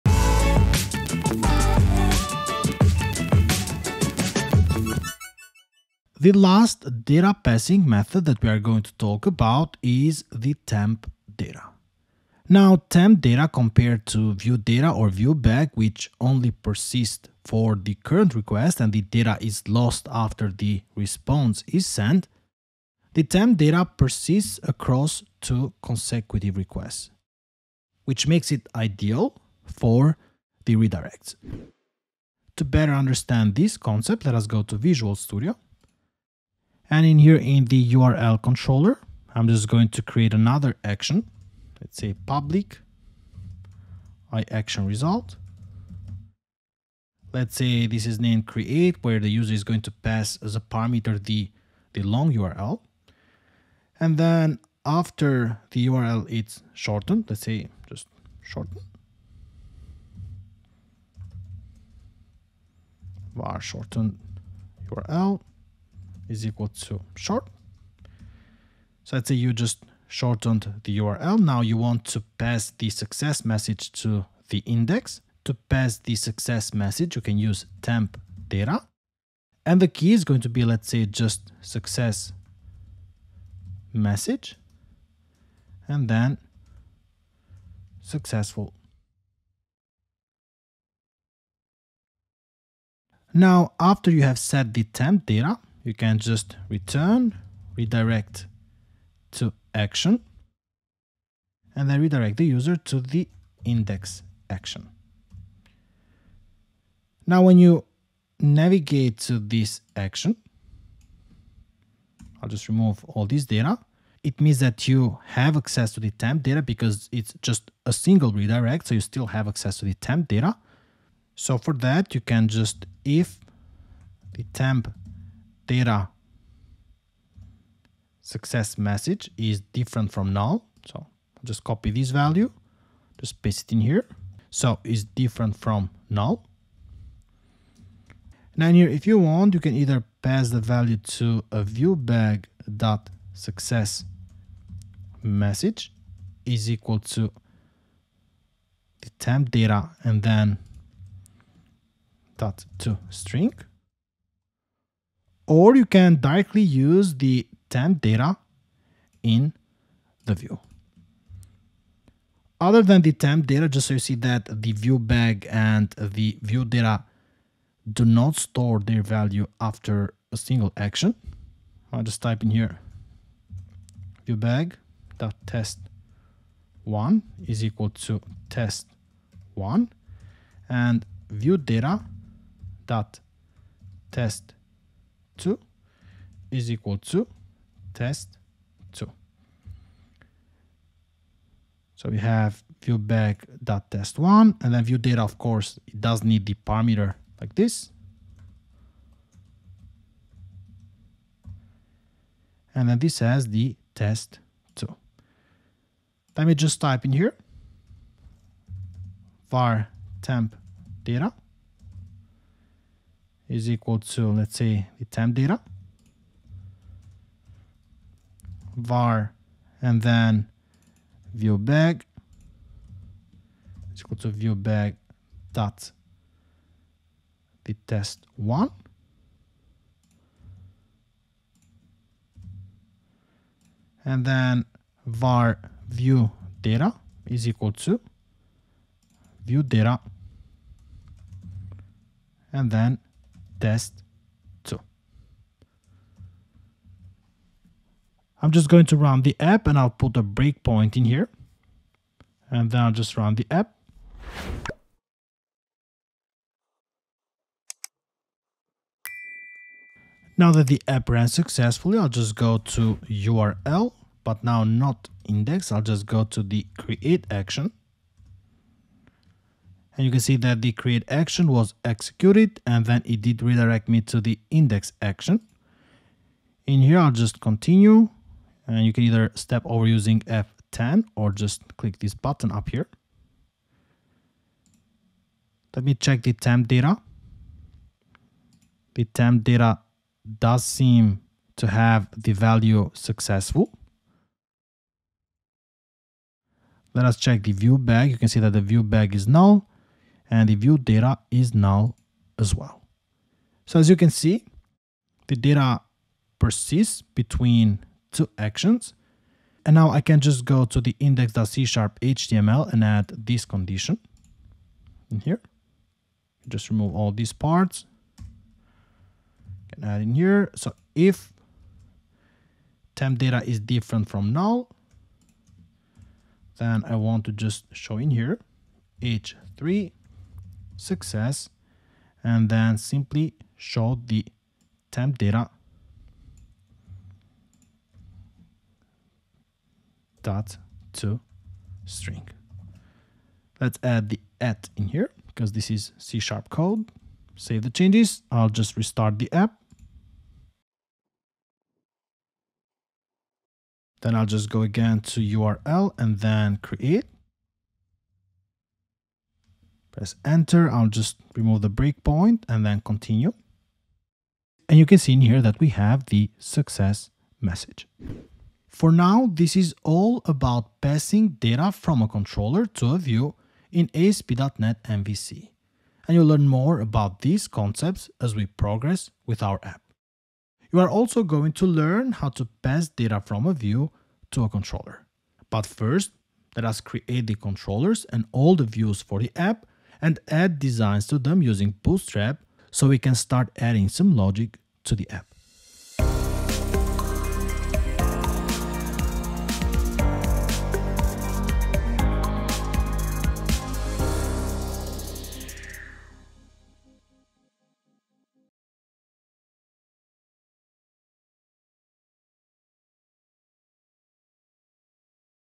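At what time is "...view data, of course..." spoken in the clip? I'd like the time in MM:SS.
03:14.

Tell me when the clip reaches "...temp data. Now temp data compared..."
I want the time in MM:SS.
00:10.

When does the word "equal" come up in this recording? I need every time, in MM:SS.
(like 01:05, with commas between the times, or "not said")
01:06, 02:26, 02:57, 03:06, 03:33, 03:44, 03:57.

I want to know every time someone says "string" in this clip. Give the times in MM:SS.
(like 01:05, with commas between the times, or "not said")
02:33, 05:41.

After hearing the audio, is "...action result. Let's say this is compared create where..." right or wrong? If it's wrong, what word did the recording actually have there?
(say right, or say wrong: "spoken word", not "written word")
wrong: "named", not "compared".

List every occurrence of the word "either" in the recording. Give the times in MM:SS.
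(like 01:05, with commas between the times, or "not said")
02:19, 04:39.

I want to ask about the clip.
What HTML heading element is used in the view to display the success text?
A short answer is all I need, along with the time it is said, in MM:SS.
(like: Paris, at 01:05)
h3, at 05:29.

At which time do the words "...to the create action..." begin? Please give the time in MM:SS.
04:26.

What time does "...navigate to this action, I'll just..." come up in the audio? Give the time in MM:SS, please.
01:48.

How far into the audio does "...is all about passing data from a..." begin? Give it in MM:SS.
06:09.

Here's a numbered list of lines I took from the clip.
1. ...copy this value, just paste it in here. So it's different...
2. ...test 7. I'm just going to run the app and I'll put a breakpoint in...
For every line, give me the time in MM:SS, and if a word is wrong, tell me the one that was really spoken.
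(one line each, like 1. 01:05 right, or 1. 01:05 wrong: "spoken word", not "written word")
1. 02:11 right
2. 04:03 wrong: "2", not "7".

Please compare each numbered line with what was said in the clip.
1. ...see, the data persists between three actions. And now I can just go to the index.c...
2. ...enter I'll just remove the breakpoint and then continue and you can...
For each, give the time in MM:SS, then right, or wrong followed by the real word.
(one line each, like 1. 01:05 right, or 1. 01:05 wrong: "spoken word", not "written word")
1. 05:04 wrong: "two", not "three"
2. 06:00 right.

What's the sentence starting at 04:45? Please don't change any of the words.
Let me check the temp data.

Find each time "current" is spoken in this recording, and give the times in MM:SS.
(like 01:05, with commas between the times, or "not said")
00:17.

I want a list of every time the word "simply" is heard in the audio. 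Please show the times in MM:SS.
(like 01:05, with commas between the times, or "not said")
05:32.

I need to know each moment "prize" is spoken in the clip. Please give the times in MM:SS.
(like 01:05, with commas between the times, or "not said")
not said.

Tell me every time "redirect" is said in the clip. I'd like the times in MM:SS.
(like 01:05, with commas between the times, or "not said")
00:30, 01:37, 01:42, 01:58, 04:33.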